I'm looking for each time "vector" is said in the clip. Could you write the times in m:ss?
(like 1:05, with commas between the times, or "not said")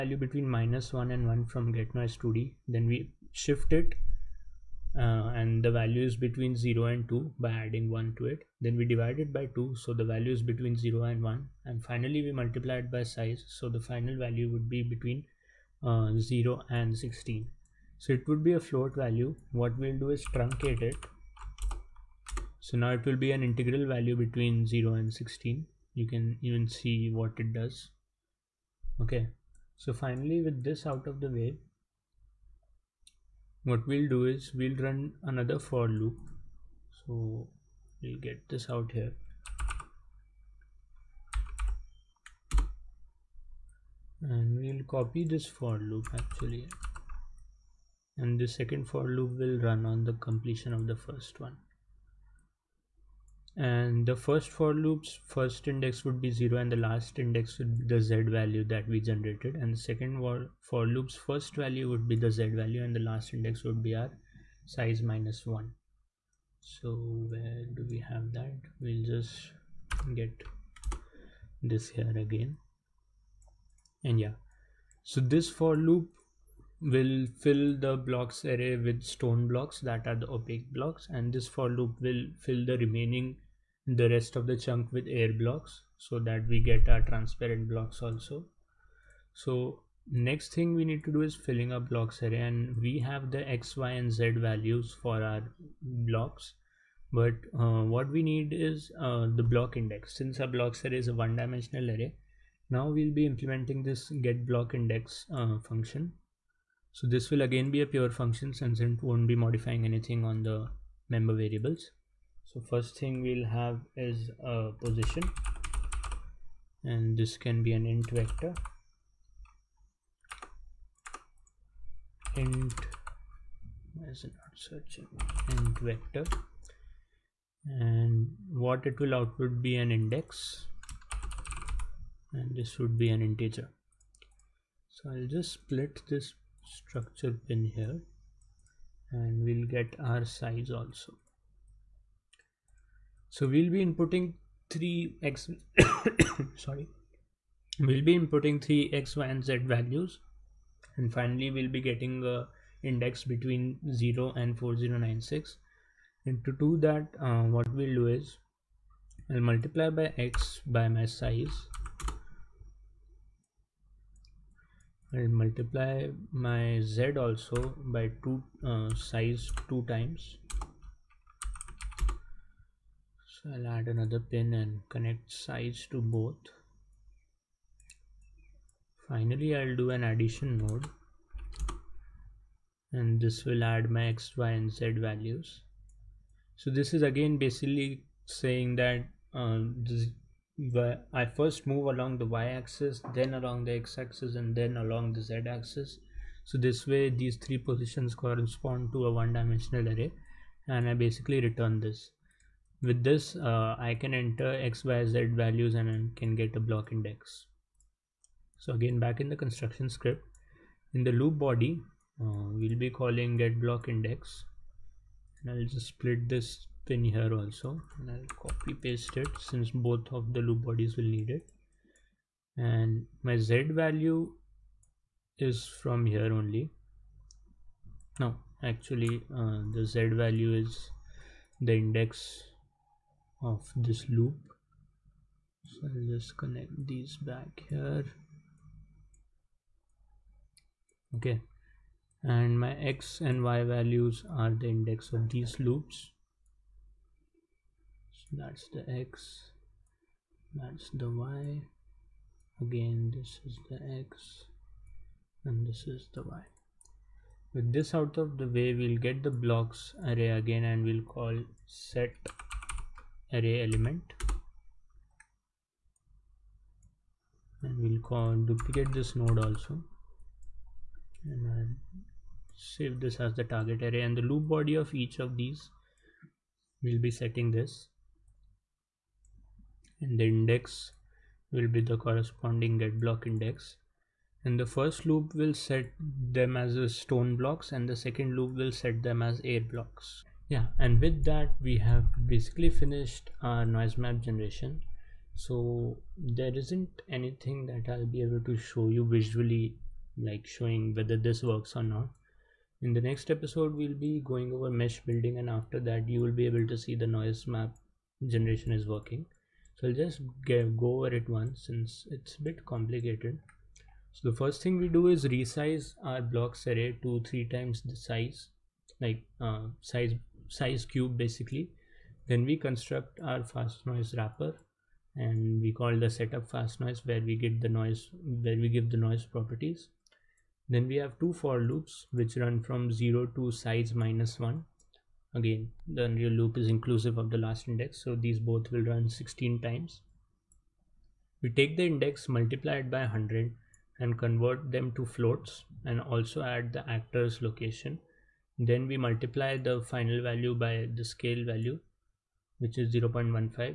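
1:58, 2:05.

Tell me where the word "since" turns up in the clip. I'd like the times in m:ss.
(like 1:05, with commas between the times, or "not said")
1:40, 1:48, 3:39, 5:11.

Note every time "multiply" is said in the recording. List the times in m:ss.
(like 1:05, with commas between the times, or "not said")
0:12, 2:39, 2:45, 5:42, 5:48.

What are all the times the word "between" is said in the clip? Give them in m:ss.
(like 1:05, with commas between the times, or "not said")
0:00, 0:06, 0:10, 0:14, 0:24, 2:33.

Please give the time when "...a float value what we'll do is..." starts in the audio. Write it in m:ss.
0:18.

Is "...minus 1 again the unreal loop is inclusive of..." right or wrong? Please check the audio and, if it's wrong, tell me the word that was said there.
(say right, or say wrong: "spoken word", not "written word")
right.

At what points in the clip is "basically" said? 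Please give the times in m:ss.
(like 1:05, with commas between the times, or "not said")
3:07, 3:20, 4:52, 5:21.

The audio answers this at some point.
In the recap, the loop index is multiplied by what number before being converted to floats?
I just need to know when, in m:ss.
5:43.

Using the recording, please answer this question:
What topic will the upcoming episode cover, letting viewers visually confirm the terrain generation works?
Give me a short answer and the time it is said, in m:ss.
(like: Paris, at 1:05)
mesh building, at 5:04.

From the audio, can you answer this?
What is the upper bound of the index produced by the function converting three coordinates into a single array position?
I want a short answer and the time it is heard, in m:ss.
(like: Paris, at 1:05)
4096, at 2:34.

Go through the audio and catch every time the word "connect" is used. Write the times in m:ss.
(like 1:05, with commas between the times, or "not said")
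2:54, 3:56.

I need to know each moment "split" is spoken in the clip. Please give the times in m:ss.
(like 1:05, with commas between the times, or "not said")
2:15, 3:35.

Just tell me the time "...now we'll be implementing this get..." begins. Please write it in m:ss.
1:42.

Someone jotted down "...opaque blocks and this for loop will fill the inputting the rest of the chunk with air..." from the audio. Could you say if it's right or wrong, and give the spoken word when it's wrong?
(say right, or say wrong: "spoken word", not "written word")
wrong: "remaining", not "inputting".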